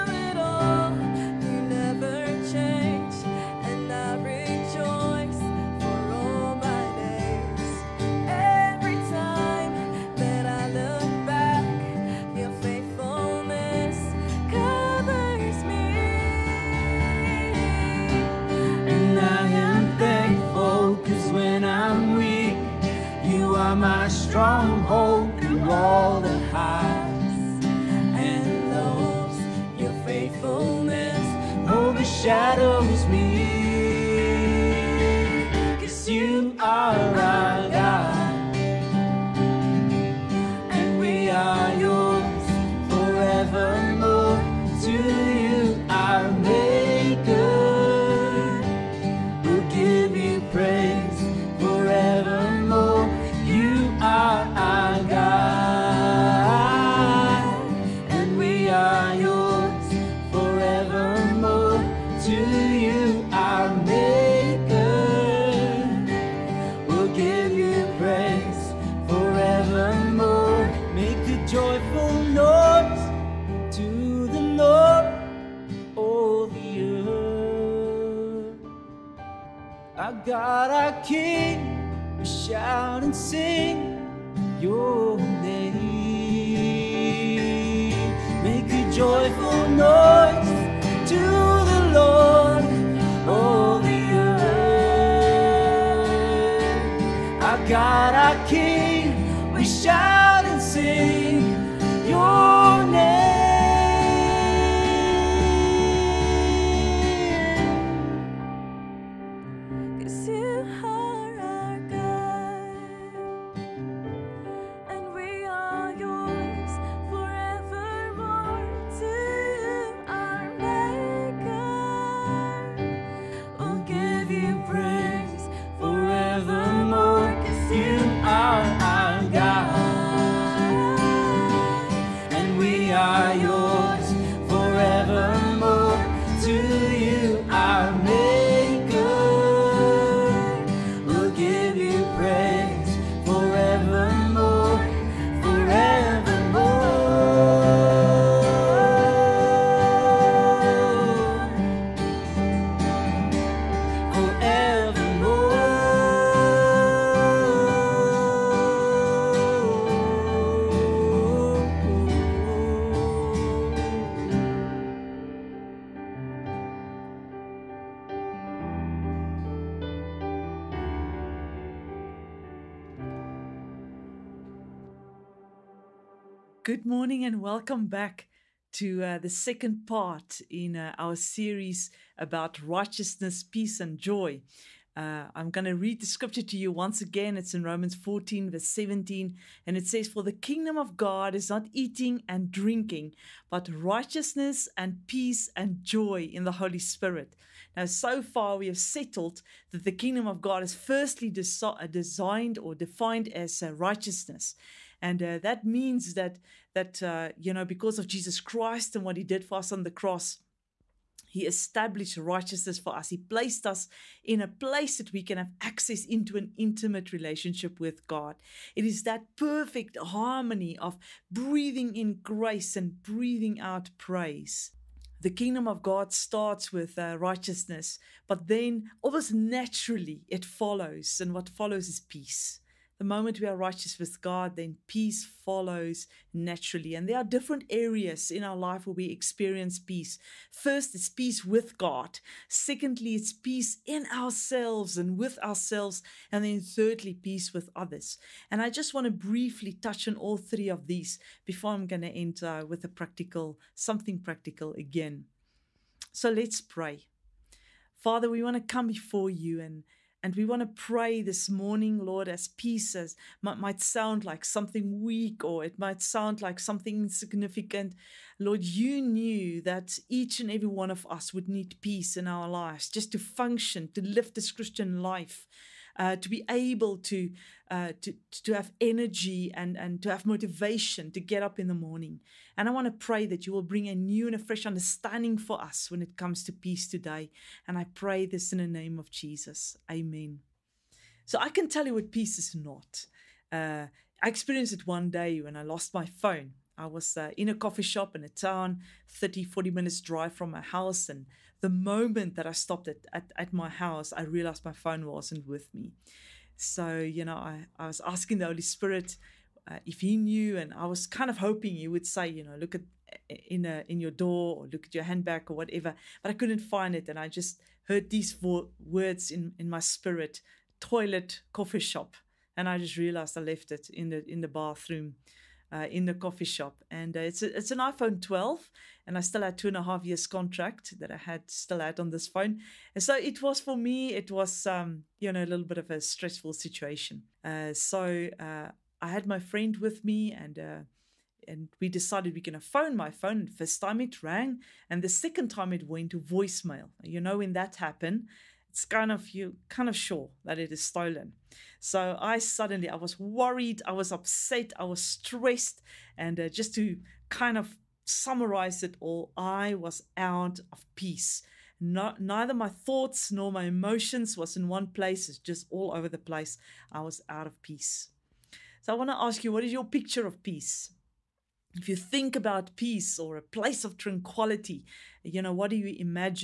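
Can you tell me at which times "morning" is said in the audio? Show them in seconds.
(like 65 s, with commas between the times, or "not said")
176 s, 261 s, 281 s.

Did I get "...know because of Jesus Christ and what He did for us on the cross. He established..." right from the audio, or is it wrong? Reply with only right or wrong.
right.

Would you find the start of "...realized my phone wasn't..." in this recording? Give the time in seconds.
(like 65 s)
304 s.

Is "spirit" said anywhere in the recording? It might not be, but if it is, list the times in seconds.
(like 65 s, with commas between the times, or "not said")
196 s, 308 s, 319 s.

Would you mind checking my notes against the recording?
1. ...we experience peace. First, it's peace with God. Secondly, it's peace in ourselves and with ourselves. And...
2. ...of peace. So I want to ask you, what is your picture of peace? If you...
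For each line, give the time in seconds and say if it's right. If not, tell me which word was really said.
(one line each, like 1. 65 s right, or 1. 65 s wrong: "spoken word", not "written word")
1. 238 s right
2. 367 s right.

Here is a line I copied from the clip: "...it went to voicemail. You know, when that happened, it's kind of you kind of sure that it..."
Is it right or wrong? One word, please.
right.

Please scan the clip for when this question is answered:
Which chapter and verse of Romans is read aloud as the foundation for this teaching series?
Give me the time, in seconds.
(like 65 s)
187 s.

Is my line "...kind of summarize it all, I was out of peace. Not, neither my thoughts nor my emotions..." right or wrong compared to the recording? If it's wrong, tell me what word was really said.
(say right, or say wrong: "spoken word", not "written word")
right.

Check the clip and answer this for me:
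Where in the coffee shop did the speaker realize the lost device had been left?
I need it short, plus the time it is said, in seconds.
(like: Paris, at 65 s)
The bathroom, at 324 s.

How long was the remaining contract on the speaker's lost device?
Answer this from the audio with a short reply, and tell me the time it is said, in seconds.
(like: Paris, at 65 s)
2 and a half years, at 329 s.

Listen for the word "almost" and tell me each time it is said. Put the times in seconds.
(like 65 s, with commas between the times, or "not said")
229 s.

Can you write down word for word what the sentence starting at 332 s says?
And so it was for me, it was, um, you know, a little bit of a stressful situation.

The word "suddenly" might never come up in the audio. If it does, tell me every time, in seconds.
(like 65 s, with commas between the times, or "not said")
352 s.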